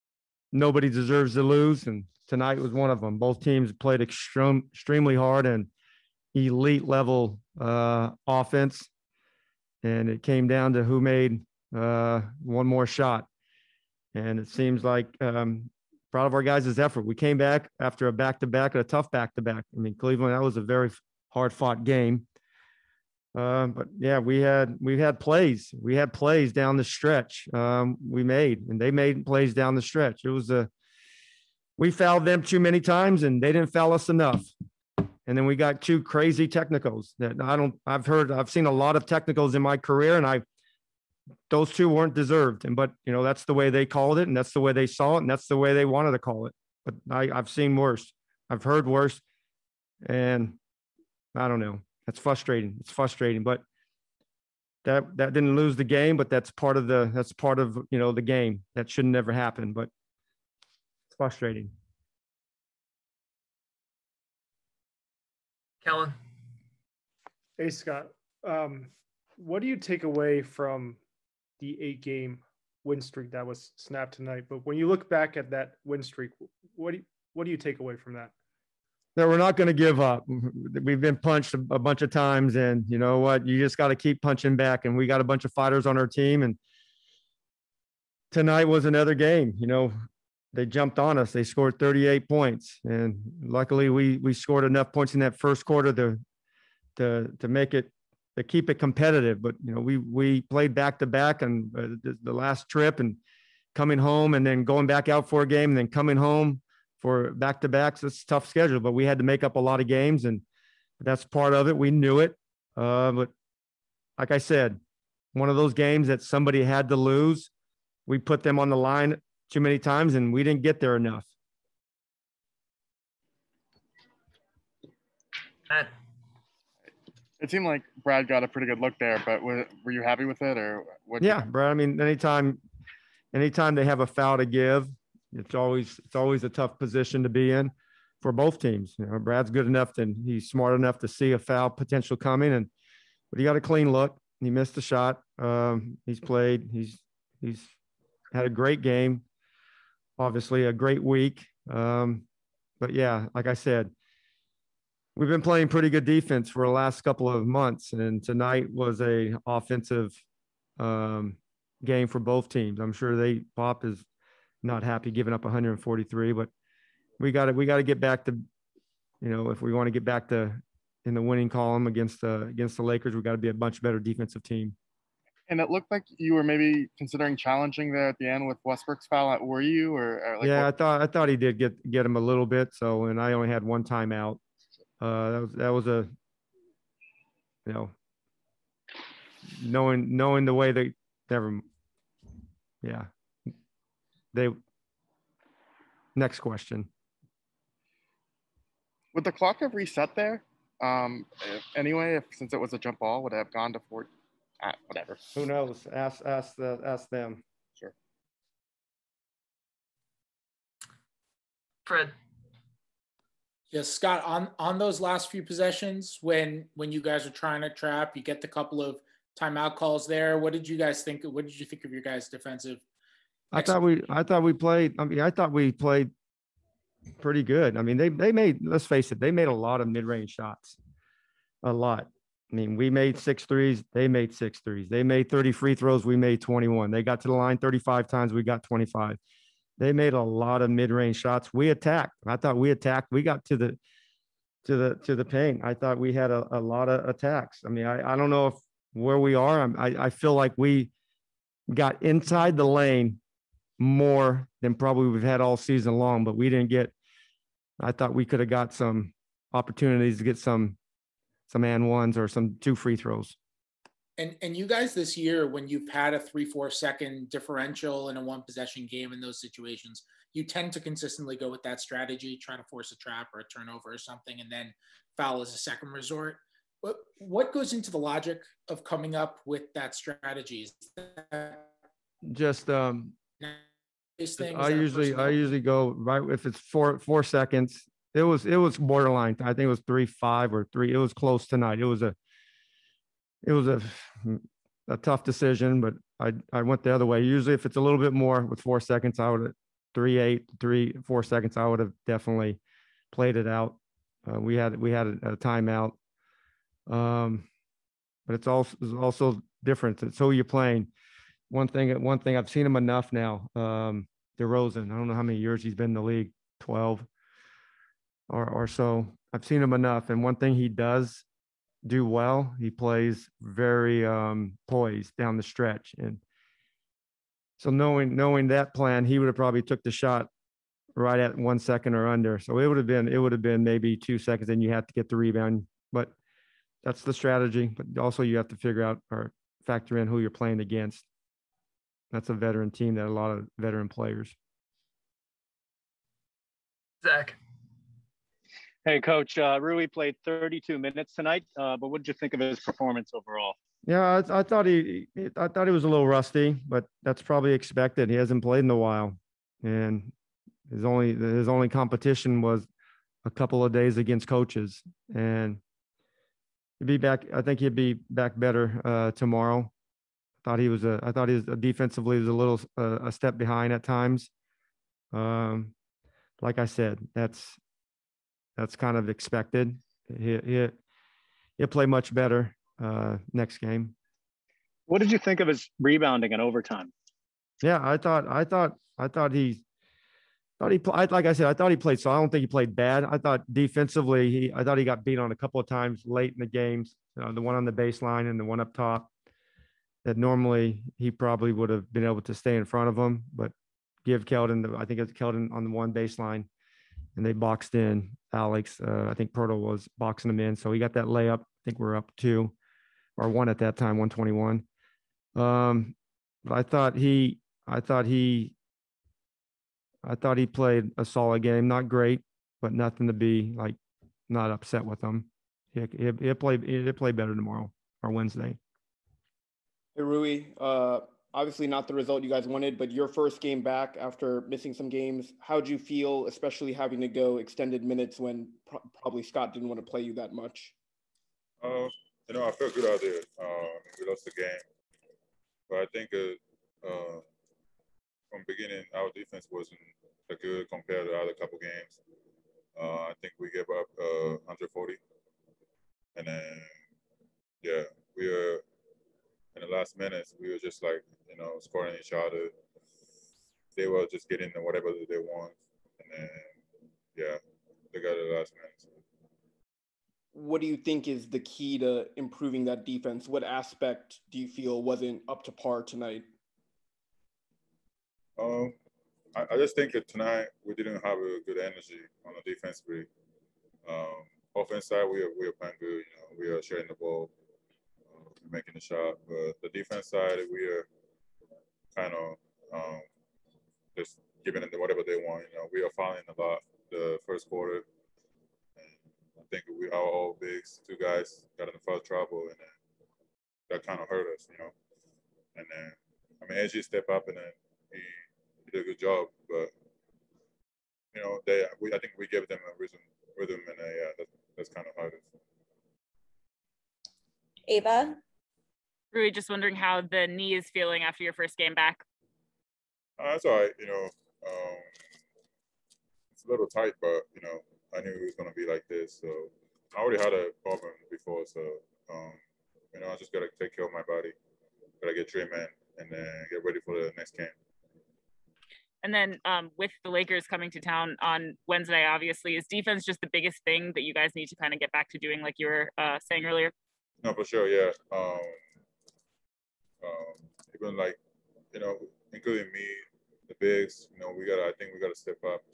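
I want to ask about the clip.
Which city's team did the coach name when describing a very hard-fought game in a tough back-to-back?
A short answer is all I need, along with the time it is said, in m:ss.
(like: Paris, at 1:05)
Cleveland, at 0:19.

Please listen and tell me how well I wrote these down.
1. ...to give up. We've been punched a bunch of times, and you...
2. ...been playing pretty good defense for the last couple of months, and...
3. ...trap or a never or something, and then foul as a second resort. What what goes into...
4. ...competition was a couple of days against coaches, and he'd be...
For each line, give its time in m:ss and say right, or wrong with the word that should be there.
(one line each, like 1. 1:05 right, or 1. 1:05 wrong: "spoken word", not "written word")
1. 1:19 right
2. 2:35 right
3. 4:32 wrong: "turnover", not "never"
4. 6:01 right.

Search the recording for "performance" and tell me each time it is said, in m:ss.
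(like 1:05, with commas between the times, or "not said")
5:52.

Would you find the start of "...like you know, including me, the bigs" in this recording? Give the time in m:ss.
9:10.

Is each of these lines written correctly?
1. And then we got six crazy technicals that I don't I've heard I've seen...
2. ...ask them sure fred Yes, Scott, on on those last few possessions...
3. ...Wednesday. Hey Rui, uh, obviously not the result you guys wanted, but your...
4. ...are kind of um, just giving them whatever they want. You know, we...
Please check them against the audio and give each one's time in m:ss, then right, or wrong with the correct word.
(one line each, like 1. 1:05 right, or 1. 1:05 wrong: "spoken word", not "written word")
1. 0:35 wrong: "two", not "six"
2. 3:26 right
3. 7:08 right
4. 8:10 right.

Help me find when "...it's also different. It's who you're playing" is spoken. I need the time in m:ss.
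5:08.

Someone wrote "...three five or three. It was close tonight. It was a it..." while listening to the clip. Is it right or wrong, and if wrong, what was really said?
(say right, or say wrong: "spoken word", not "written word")
right.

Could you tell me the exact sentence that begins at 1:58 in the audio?
We put them on the line too many times, and we didn't get there enough.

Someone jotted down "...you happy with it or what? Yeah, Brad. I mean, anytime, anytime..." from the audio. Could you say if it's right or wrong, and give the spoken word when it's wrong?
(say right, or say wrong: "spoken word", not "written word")
right.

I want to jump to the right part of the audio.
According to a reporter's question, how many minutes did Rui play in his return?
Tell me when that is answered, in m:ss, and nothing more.
5:50.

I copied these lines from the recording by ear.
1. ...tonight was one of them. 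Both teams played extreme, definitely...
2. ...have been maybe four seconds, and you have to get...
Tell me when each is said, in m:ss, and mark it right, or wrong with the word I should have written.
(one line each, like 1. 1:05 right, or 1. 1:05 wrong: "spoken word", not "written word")
1. 0:02 wrong: "extremely", not "definitely"
2. 5:33 wrong: "two", not "four".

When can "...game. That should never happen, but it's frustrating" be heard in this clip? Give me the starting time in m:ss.
0:58.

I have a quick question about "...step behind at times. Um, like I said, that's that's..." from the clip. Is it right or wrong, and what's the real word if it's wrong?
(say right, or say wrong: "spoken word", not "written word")
right.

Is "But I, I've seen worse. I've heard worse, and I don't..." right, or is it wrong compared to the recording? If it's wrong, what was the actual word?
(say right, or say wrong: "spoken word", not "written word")
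right.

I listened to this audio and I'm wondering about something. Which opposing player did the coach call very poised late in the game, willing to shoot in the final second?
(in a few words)
DeRozan.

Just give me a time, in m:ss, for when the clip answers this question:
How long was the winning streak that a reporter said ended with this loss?
1:11.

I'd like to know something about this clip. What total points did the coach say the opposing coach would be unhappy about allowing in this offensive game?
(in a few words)
143.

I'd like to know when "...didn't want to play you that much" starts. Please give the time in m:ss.
7:19.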